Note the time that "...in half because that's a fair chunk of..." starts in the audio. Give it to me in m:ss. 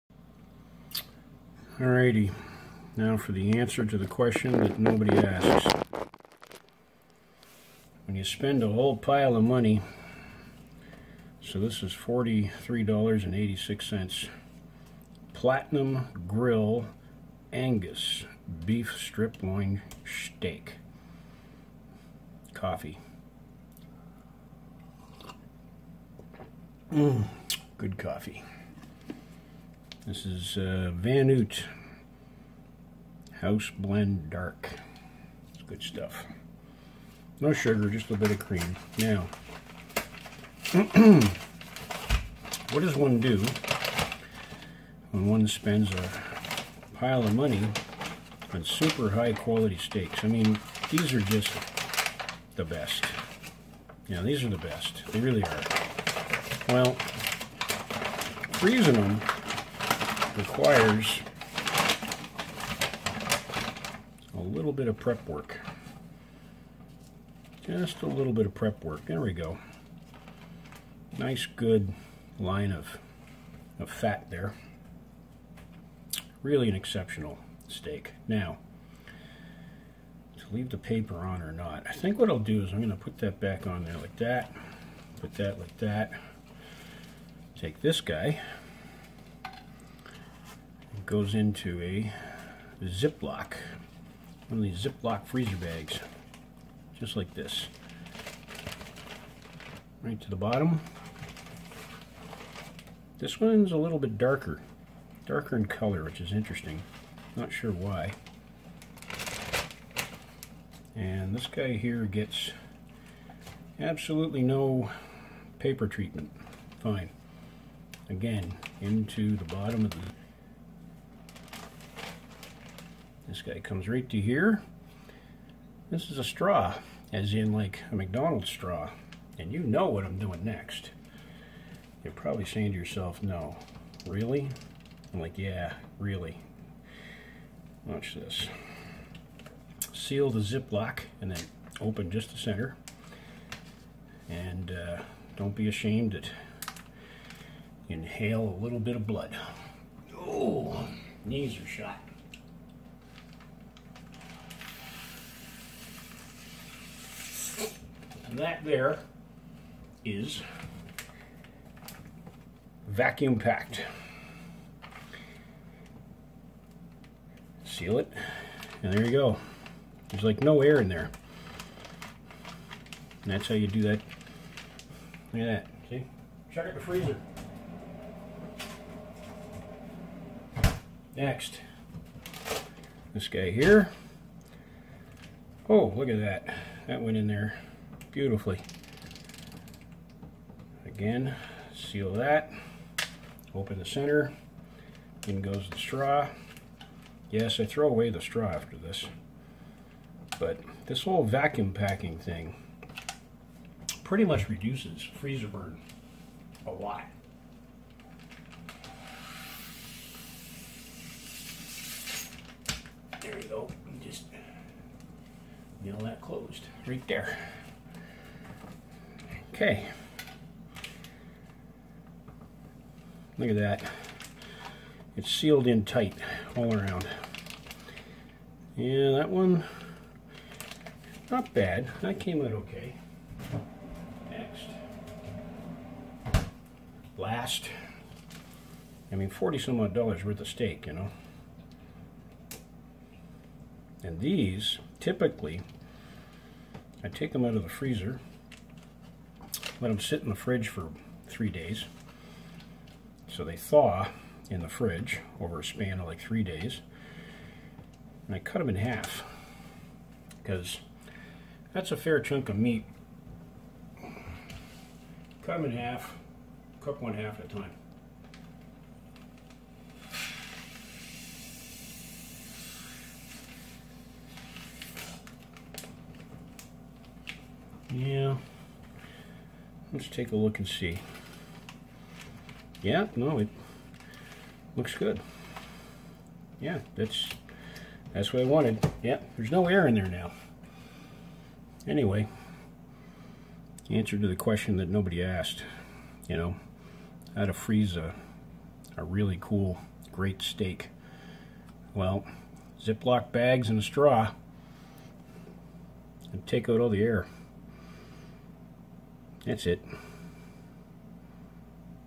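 4:18.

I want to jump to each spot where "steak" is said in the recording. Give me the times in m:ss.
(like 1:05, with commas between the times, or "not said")
0:20, 0:49, 1:17, 4:00, 5:00.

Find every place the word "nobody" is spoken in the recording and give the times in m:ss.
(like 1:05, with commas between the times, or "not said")
0:04, 4:54.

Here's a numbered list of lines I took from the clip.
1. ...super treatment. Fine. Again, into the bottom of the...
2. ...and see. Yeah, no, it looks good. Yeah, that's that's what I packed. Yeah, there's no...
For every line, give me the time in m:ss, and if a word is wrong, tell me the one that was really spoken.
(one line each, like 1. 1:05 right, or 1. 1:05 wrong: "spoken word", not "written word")
1. 1:55 wrong: "paper", not "super"
2. 4:40 wrong: "wanted", not "packed".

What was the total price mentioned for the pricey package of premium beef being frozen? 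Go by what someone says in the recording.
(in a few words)
$43.86.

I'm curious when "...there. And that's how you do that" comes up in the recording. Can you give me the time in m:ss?
2:50.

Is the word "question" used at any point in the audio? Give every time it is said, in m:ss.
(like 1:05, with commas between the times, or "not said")
0:04, 4:54.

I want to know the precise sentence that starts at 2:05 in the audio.
This is a straw, as in like a McDonald's straw.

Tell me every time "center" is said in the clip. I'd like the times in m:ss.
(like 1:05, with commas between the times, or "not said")
2:22, 3:13.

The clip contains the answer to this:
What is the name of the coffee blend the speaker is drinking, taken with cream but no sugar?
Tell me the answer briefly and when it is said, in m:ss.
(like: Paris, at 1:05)
House Blend Dark, at 0:33.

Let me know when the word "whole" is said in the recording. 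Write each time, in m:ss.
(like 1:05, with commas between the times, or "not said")
0:08, 3:21.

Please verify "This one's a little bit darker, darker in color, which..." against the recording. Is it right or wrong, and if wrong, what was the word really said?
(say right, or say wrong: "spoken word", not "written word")
right.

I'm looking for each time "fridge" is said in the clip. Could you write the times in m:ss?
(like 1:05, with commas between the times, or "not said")
4:10, 4:14.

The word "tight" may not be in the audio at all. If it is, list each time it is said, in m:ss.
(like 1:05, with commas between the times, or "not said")
3:45.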